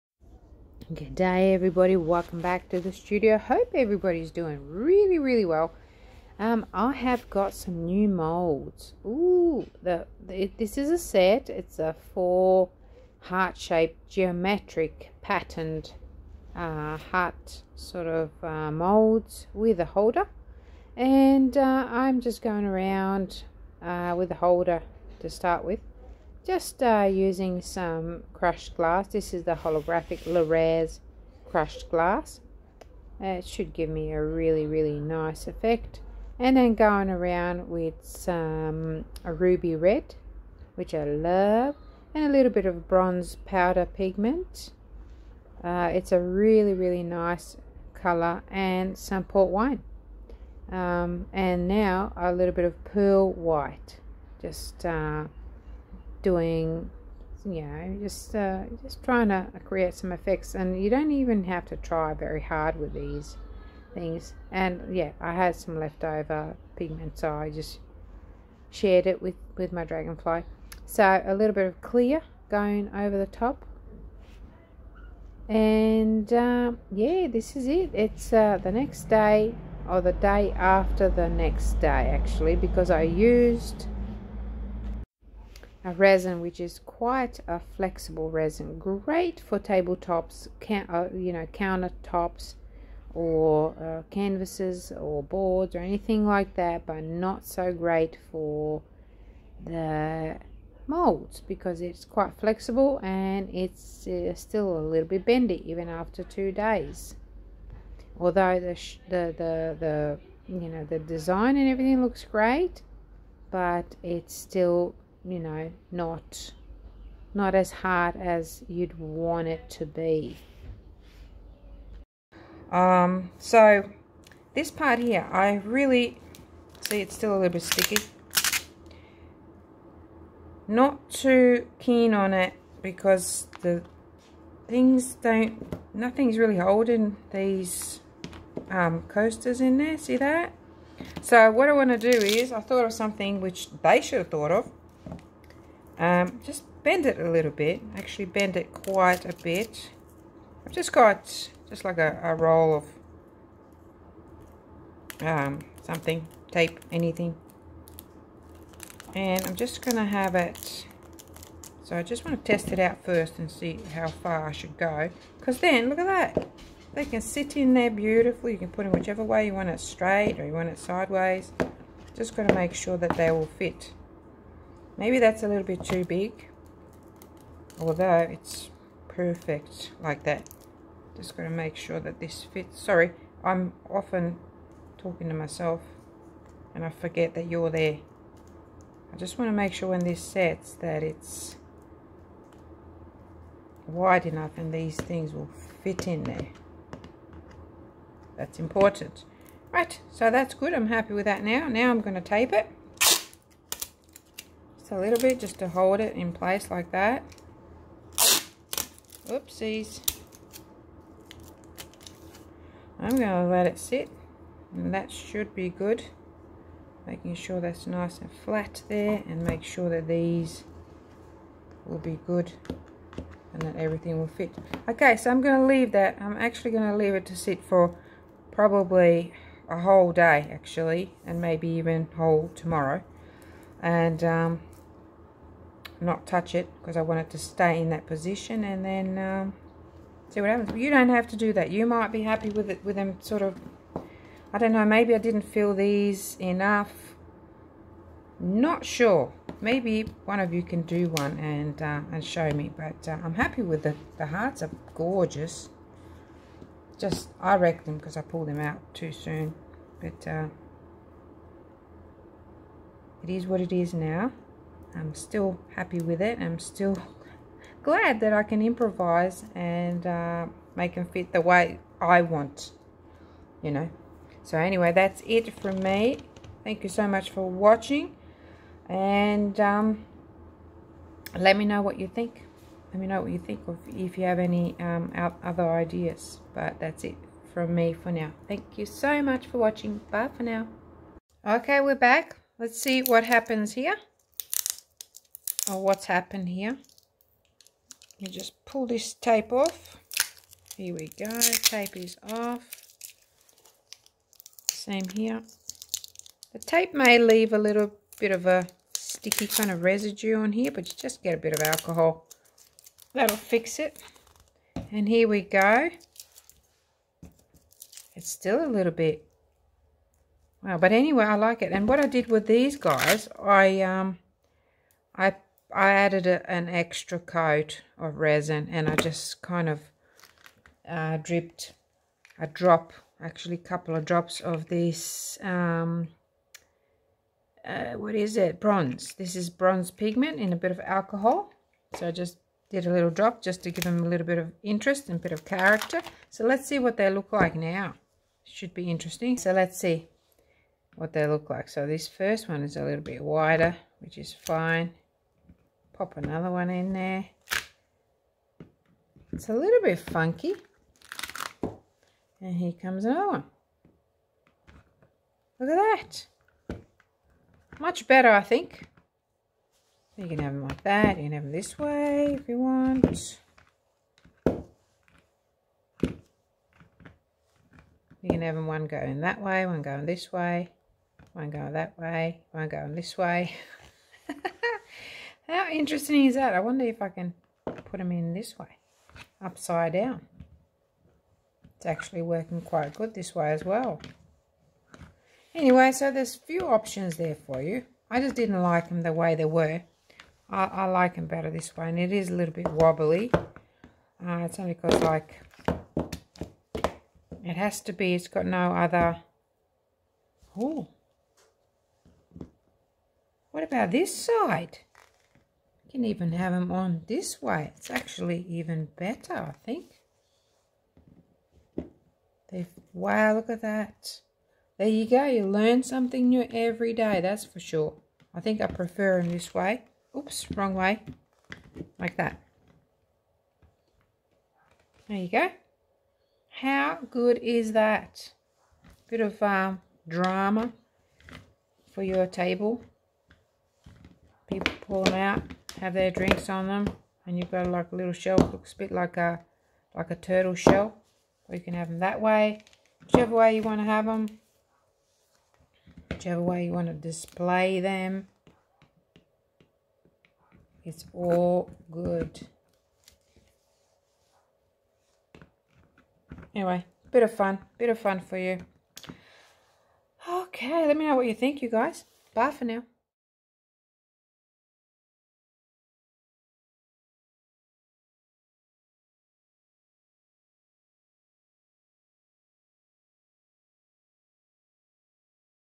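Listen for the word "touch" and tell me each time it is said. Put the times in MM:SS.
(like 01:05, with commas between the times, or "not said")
03:56.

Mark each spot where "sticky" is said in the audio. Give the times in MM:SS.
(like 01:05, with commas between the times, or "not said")
02:07, 05:08.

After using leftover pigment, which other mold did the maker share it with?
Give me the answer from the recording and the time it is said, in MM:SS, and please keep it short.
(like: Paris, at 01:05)
dragonfly, at 01:09.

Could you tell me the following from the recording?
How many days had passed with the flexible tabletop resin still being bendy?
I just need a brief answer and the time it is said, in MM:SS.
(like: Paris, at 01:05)
2, at 01:46.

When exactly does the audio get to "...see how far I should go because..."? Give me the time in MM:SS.
02:43.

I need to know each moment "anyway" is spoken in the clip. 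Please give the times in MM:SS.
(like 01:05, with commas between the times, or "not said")
04:34, 05:20, 06:35, 07:46.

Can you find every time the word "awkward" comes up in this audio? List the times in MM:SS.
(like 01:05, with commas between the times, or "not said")
not said.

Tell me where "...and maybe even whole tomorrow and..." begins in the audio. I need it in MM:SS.
03:51.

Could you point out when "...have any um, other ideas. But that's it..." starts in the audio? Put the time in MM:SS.
04:44.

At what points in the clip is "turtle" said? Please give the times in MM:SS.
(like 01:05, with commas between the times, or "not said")
07:30.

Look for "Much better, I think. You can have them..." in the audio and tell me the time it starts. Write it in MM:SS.
06:07.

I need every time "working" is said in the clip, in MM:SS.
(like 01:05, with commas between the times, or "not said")
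06:32.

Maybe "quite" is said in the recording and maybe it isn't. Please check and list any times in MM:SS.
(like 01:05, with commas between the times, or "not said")
01:26, 01:42, 02:28, 06:32.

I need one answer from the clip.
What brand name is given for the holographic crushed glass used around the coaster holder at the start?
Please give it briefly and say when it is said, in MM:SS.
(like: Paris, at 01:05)
Le'Rez, at 00:30.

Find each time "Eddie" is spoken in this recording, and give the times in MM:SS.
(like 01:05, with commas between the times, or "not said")
not said.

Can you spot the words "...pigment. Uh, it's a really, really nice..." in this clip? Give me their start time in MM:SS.
00:43.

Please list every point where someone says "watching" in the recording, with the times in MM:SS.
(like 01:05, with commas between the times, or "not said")
04:37, 04:49.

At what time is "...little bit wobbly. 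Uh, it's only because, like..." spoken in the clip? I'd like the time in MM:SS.
06:42.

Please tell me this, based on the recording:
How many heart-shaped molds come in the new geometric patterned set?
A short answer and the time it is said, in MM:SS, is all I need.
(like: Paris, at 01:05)
4, at 00:12.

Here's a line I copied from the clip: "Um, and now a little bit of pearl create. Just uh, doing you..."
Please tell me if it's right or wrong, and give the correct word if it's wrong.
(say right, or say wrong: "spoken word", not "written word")
wrong: "white", not "create".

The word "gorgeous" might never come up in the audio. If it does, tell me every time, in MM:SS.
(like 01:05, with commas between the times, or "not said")
04:14.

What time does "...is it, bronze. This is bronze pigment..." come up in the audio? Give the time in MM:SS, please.
05:38.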